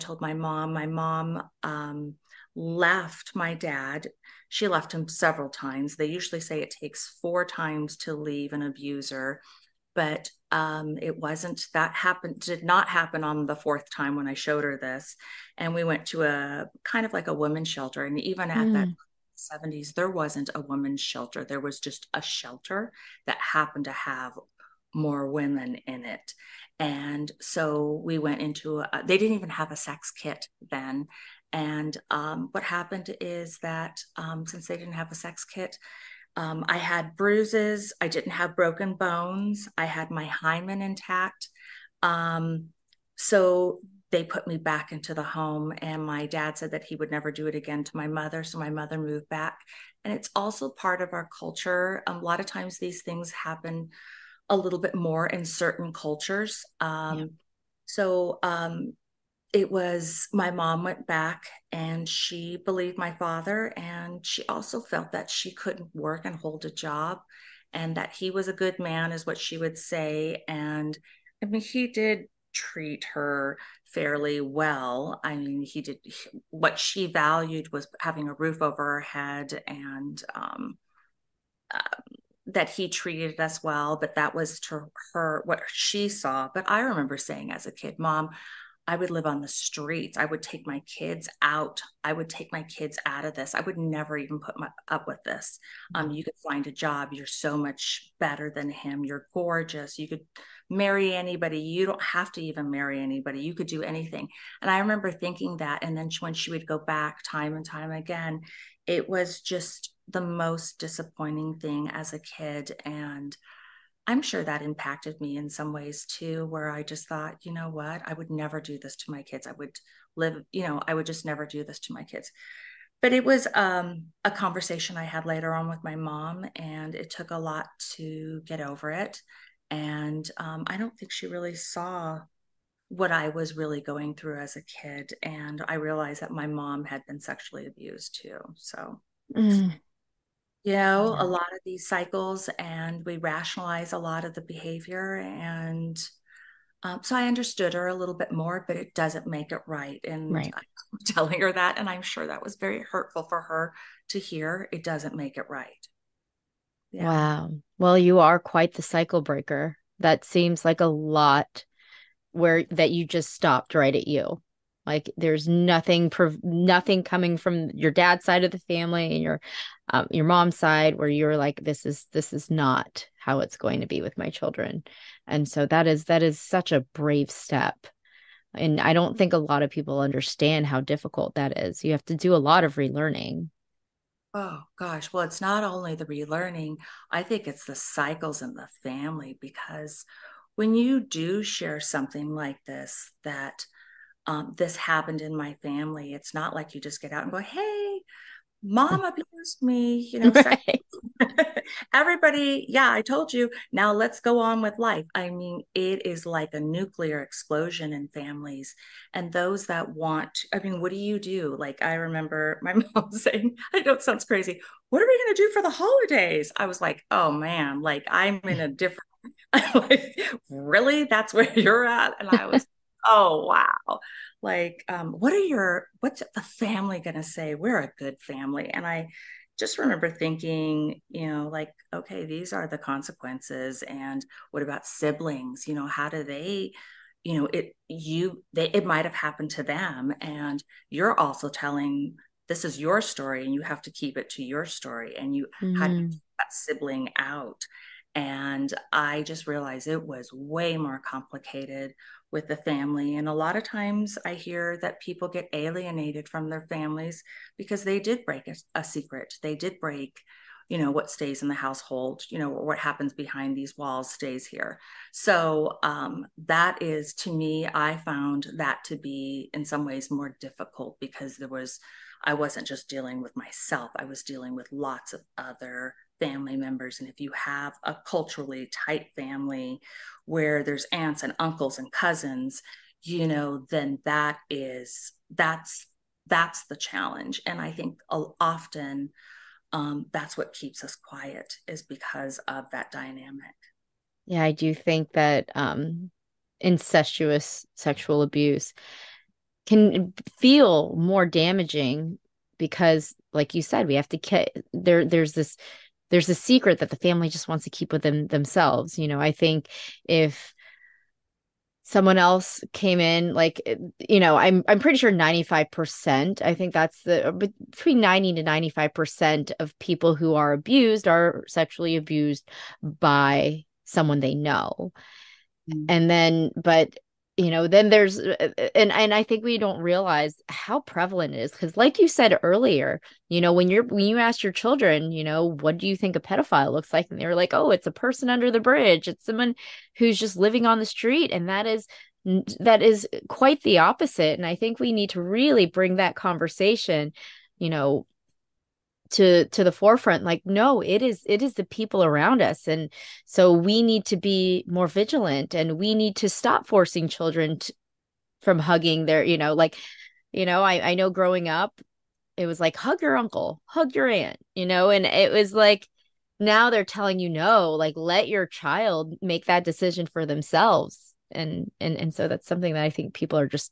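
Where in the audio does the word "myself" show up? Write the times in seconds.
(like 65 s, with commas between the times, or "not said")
273 s.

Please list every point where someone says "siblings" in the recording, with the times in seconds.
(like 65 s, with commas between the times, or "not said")
234 s, 246 s.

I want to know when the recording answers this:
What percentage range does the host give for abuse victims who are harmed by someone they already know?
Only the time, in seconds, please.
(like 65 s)
318 s.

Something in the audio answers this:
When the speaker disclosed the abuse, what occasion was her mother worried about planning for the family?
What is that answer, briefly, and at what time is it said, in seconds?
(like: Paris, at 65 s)
the holidays, at 215 s.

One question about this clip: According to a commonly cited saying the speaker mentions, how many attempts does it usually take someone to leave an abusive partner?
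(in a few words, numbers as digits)
4.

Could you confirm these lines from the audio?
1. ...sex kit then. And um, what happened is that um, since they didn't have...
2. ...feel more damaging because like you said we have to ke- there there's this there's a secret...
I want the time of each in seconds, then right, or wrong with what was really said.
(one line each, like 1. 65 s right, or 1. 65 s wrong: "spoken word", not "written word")
1. 29 s right
2. 300 s right.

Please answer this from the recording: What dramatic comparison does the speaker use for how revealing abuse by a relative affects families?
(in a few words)
nuclear explosion.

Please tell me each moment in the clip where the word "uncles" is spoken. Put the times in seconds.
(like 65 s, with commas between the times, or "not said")
281 s, 363 s.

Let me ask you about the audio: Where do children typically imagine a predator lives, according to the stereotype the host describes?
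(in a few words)
under the bridge.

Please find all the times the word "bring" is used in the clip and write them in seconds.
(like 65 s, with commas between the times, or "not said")
345 s.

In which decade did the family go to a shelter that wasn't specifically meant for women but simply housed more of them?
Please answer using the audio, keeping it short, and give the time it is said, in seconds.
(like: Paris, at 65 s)
1970s, at 19 s.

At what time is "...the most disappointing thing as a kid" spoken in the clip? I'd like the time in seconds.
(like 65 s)
110 s.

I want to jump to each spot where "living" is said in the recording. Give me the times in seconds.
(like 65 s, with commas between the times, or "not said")
340 s.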